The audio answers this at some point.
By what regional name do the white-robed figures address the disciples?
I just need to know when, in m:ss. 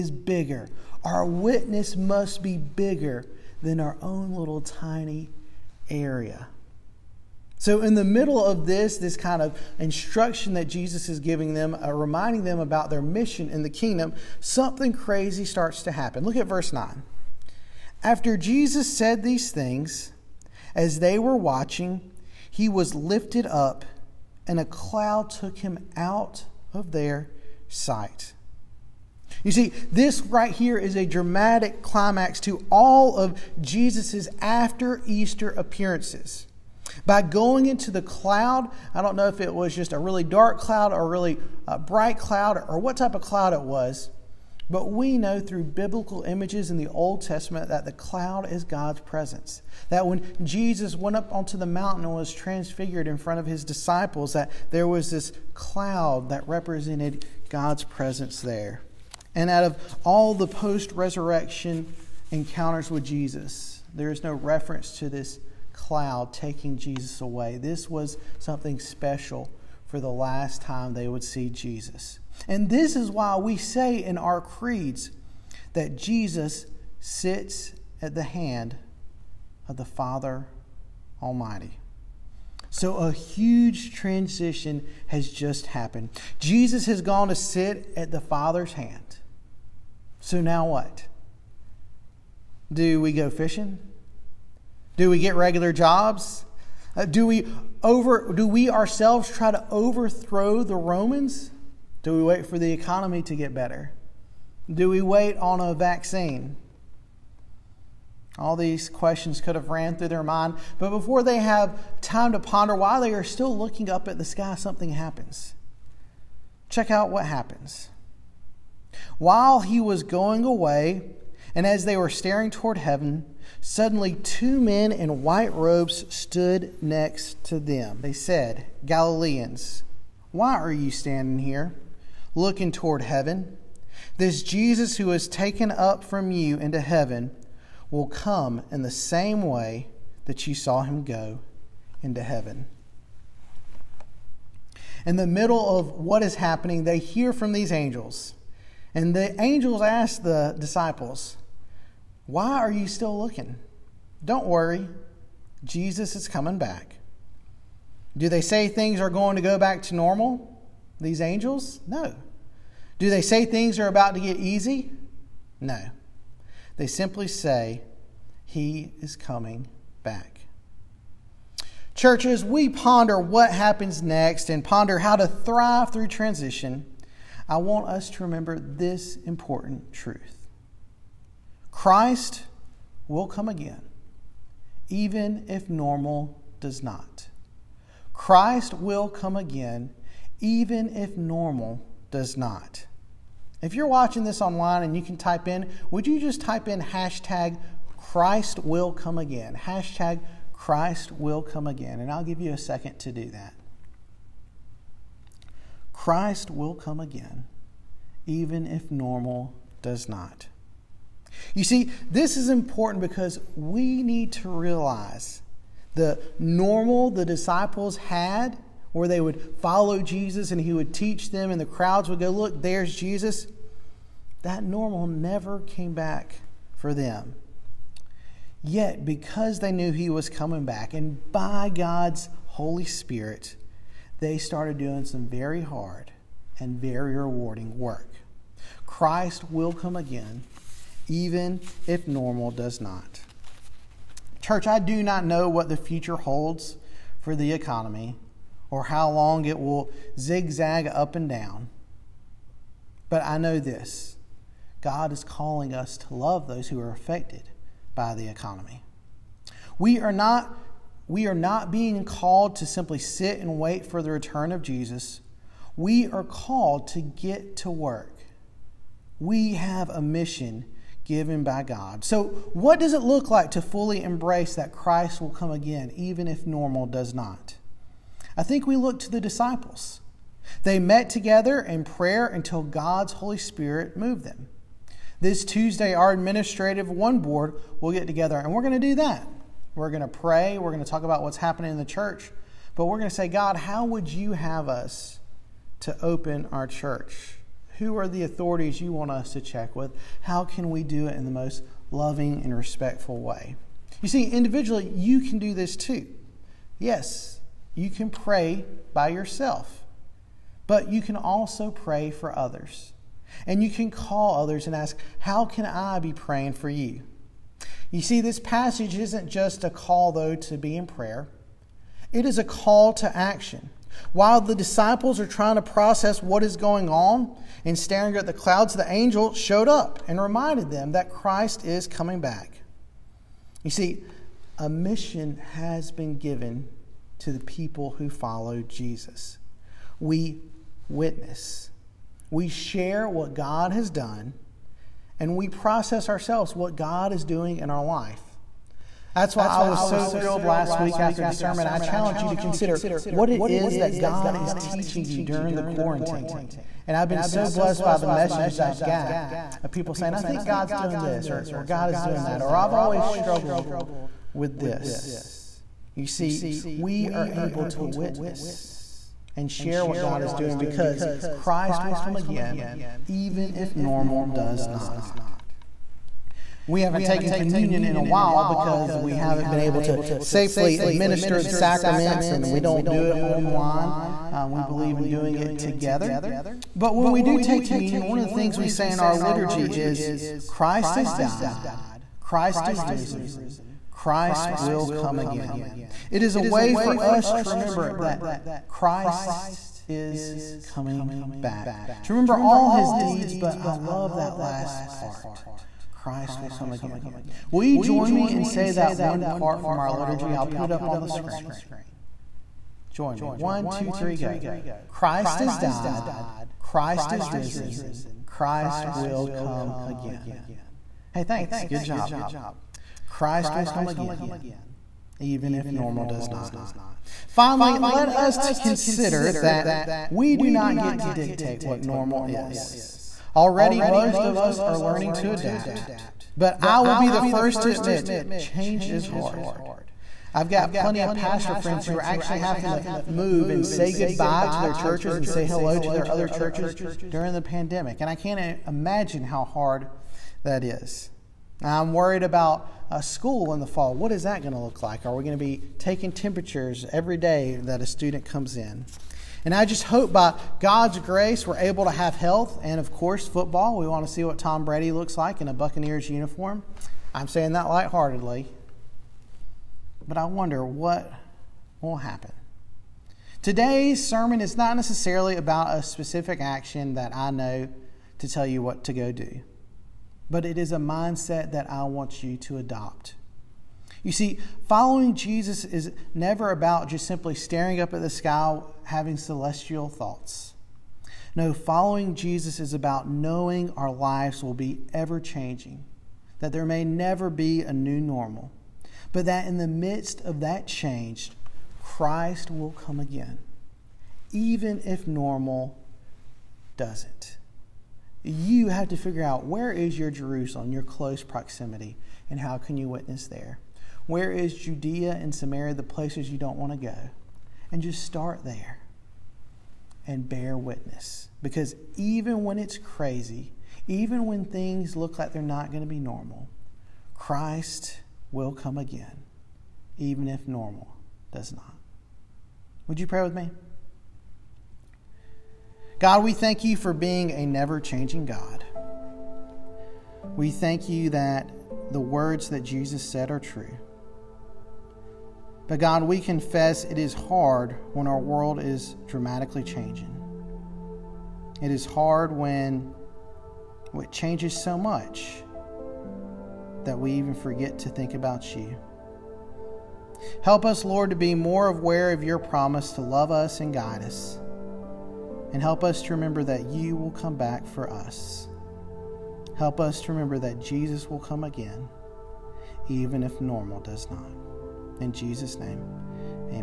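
2:08.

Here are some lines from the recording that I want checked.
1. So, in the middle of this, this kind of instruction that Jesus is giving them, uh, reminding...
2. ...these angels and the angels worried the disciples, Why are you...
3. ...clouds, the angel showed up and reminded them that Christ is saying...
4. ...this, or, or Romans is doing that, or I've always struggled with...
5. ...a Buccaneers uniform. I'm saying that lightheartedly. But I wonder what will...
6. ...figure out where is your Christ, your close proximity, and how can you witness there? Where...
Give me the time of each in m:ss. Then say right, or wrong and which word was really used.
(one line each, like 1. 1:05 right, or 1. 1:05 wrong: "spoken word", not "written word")
1. 0:07 right
2. 2:27 wrong: "asked", not "worried"
3. 5:28 wrong: "coming", not "saying"
4. 6:01 wrong: "God", not "Romans"
5. 7:45 right
6. 8:28 wrong: "Jerusalem", not "Christ".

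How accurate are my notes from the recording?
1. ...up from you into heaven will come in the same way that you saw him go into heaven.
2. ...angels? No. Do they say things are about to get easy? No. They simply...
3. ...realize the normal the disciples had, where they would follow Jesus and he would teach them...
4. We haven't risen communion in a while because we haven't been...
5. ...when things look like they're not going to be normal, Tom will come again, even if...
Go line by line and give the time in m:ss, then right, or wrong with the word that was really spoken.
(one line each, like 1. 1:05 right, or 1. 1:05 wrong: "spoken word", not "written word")
1. 2:15 right
2. 2:41 right
3. 3:34 right
4. 6:16 wrong: "taken", not "risen"
5. 8:44 wrong: "Christ", not "Tom".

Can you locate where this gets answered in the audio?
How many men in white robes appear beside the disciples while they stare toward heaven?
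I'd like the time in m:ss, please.
2:04.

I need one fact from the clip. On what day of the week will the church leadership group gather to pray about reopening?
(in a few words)
Tuesday.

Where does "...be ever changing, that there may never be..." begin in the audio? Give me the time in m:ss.
8:14.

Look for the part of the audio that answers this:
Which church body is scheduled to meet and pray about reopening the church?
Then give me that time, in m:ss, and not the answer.
4:46.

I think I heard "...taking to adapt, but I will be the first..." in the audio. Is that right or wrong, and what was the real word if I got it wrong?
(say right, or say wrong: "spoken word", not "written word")
wrong: "learning", not "taking".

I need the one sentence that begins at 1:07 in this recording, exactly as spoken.
This was something special for the last time they would see Jesus.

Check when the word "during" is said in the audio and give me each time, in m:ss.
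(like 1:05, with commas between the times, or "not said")
5:55, 7:27.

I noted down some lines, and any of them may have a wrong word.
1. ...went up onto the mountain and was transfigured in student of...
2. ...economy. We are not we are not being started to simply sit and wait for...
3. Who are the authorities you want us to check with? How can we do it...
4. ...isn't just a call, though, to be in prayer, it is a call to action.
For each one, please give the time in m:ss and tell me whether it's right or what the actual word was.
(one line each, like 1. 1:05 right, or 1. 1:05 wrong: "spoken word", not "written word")
1. 0:50 wrong: "front", not "student"
2. 4:18 wrong: "called", not "started"
3. 4:57 right
4. 5:18 right.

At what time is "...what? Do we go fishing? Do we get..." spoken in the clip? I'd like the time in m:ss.
1:30.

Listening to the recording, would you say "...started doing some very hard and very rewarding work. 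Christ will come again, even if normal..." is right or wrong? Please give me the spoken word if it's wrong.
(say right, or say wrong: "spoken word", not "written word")
right.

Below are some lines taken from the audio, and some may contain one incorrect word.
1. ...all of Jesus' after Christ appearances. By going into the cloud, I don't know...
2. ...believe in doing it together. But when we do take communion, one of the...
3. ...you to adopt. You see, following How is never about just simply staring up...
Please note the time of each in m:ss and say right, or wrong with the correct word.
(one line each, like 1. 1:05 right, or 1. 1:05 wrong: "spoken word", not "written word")
1. 0:32 wrong: "Easter", not "Christ"
2. 6:24 right
3. 8:02 wrong: "Jesus", not "How".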